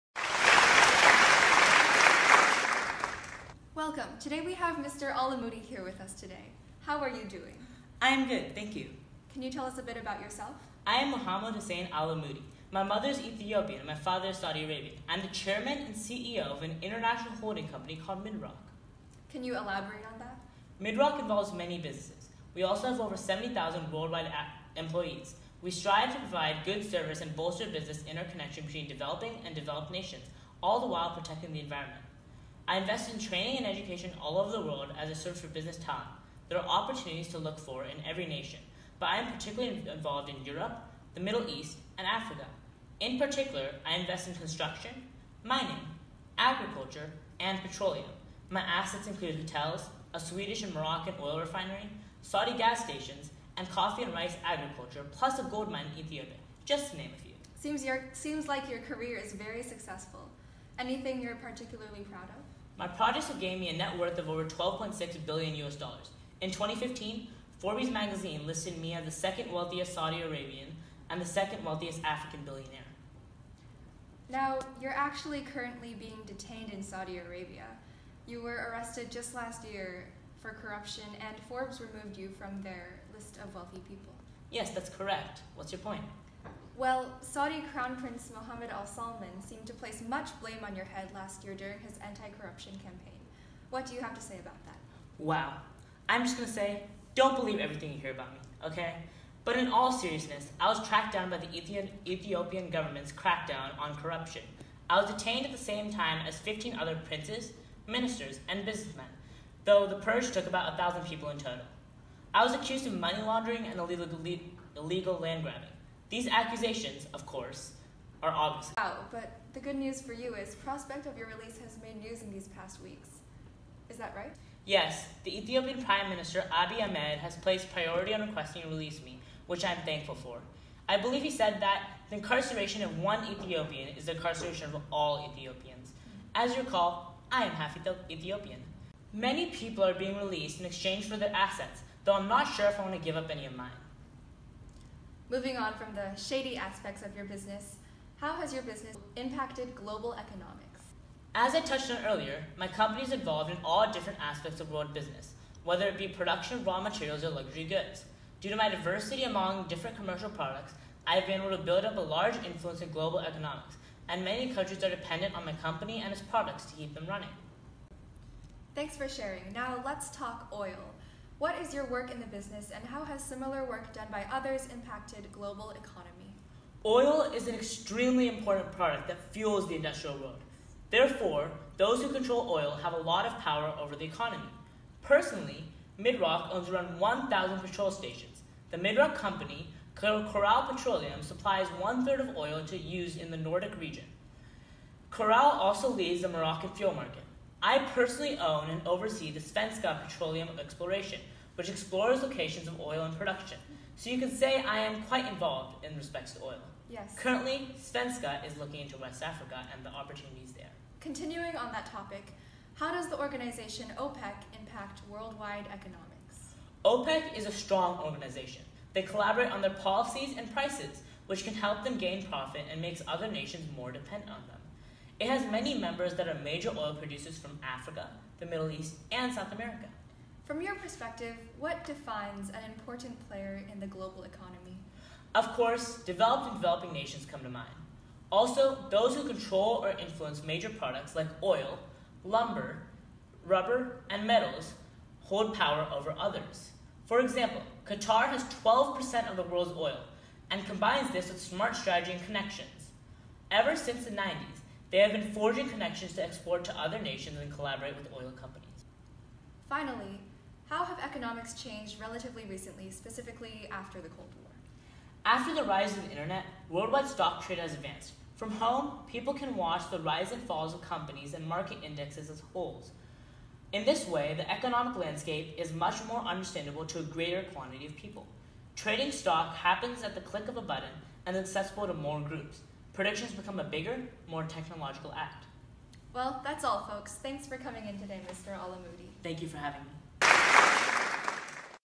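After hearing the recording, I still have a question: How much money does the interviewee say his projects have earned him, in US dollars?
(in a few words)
12.6 billion US dollars.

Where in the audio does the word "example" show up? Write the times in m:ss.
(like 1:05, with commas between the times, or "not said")
4:07.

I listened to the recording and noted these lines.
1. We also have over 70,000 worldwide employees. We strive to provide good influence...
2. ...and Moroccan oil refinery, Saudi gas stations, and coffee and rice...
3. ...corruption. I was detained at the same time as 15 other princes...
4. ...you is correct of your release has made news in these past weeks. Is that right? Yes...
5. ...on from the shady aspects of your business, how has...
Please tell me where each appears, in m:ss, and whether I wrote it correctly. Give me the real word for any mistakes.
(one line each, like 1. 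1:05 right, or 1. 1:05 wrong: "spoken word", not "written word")
1. 0:22 wrong: "service", not "influence"
2. 0:50 right
3. 1:43 right
4. 2:00 wrong: "prospect", not "correct"
5. 2:25 right.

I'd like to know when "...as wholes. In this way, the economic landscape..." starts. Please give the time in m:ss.
4:32.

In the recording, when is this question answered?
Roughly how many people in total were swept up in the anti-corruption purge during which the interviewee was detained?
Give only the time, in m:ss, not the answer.
1:50.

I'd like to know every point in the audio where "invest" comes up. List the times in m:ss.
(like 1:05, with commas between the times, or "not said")
0:32, 0:43.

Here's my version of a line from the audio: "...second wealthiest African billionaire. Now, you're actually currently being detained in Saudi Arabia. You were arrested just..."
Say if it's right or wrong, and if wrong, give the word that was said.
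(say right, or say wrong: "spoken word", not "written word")
right.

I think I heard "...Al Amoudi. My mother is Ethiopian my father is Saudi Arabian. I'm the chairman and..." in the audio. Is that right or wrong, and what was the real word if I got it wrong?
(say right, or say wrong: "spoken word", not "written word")
right.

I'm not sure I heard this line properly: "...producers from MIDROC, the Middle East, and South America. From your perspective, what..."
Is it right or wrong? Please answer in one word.
wrong.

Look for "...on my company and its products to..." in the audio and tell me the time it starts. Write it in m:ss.
2:45.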